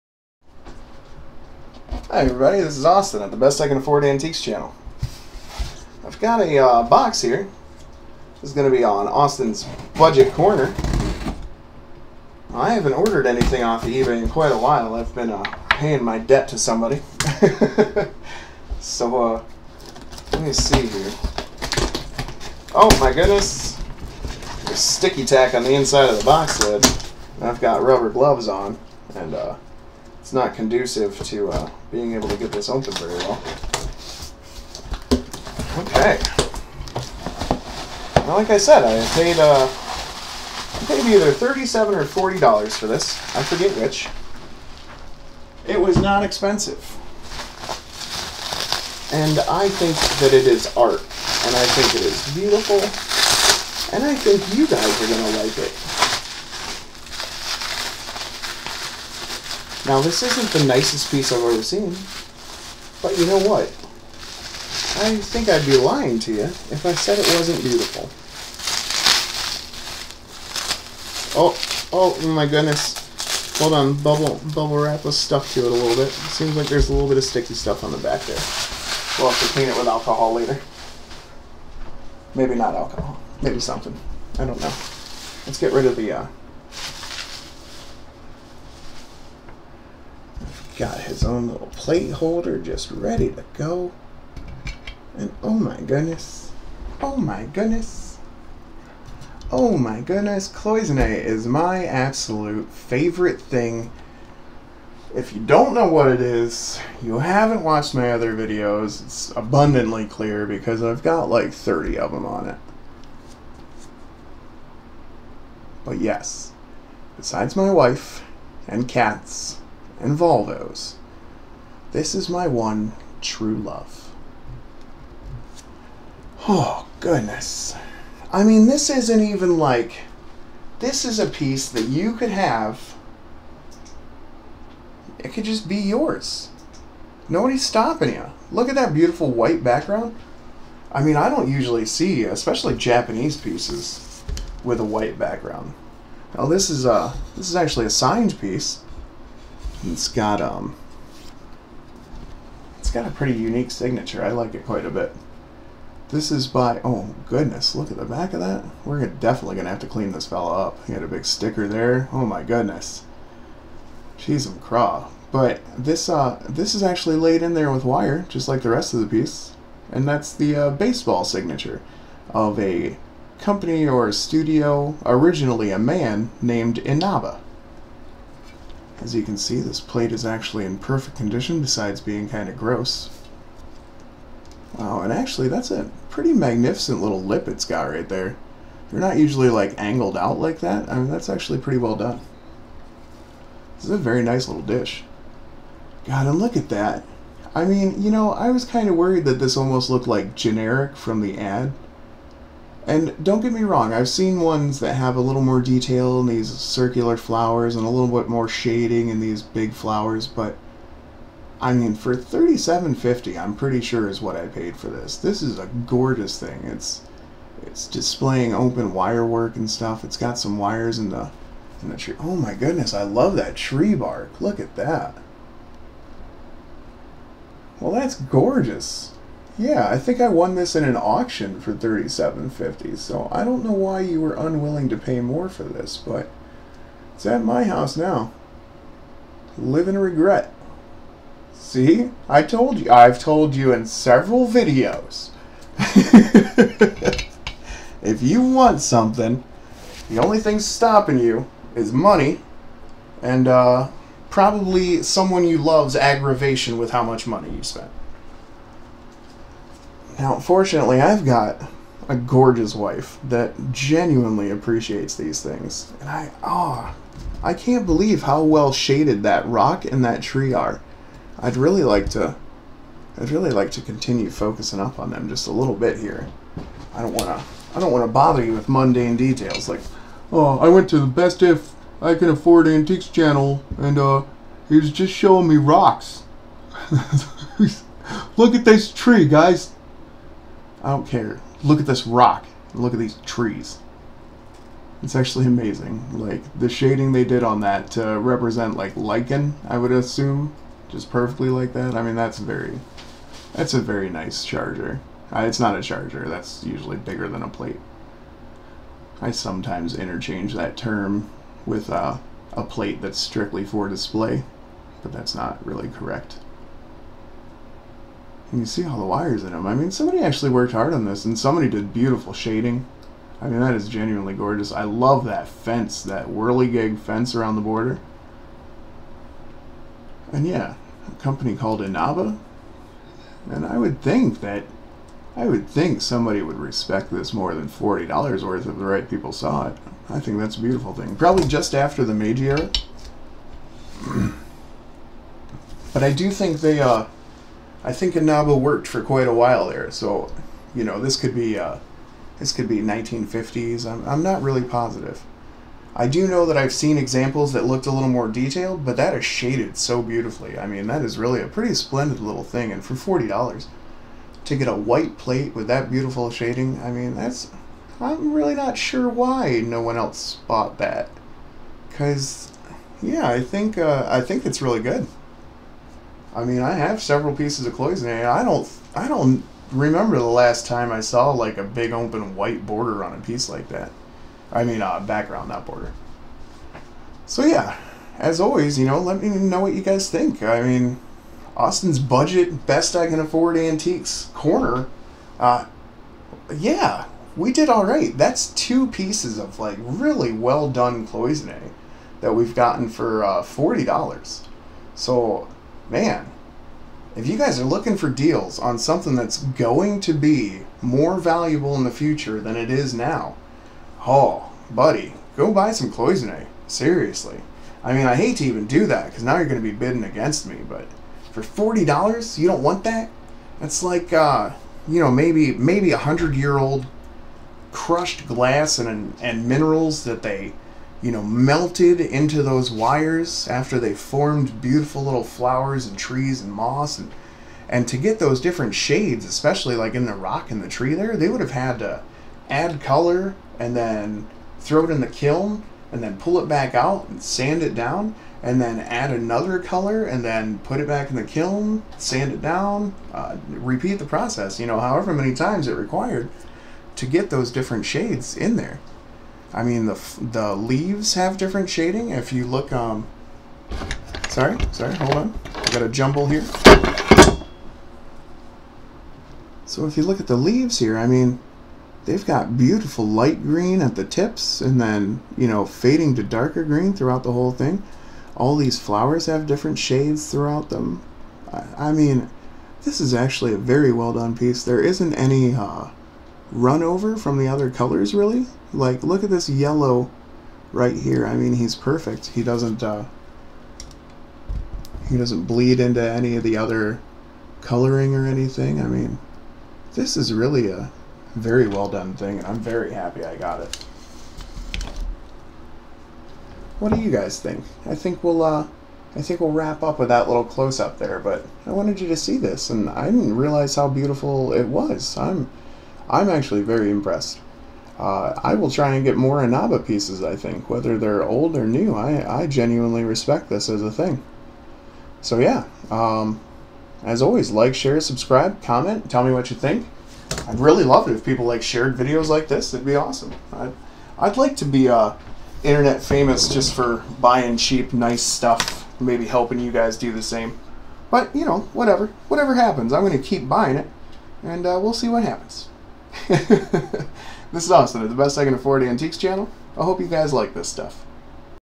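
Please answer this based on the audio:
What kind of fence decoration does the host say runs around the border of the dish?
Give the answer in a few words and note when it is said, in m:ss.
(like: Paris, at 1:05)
whirligig fence, at 5:26.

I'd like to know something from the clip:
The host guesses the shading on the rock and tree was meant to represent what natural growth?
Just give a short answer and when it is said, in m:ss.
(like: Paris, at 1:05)
lichen, at 4:58.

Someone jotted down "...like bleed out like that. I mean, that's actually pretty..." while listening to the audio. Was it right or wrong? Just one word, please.
wrong.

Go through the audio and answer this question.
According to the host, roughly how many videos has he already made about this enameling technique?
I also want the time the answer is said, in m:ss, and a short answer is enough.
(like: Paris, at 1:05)
30, at 1:51.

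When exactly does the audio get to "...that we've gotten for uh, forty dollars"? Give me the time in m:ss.
6:42.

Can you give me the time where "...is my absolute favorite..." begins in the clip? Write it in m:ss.
1:41.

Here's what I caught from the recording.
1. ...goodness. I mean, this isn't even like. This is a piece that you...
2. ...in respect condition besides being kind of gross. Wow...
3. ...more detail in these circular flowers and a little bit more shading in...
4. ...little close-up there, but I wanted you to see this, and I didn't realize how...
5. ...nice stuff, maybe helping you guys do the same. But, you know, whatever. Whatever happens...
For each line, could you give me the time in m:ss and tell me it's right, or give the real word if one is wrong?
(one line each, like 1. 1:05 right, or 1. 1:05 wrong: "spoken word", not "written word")
1. 2:06 right
2. 3:00 wrong: "perfect", not "respect"
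3. 3:25 right
4. 8:30 right
5. 8:57 right.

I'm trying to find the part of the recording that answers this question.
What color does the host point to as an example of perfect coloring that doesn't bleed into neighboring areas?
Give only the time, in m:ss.
8:09.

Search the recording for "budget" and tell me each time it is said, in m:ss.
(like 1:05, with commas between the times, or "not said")
0:09, 6:31.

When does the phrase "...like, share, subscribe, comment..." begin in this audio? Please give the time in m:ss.
8:47.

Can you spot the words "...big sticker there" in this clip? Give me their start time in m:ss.
2:41.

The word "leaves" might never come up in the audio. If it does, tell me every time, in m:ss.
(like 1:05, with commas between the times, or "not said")
7:40, 7:50.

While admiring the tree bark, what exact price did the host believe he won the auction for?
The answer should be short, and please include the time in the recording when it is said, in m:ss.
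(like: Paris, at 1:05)
37.50, at 3:51.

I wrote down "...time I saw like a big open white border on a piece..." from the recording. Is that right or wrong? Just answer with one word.
right.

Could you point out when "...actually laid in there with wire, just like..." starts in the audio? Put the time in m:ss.
2:46.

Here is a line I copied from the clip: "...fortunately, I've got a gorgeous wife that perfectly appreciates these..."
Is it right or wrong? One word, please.
wrong.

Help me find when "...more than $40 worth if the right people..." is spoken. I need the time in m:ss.
5:37.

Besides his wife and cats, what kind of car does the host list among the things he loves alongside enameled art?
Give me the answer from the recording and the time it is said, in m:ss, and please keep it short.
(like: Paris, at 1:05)
Volvos, at 2:00.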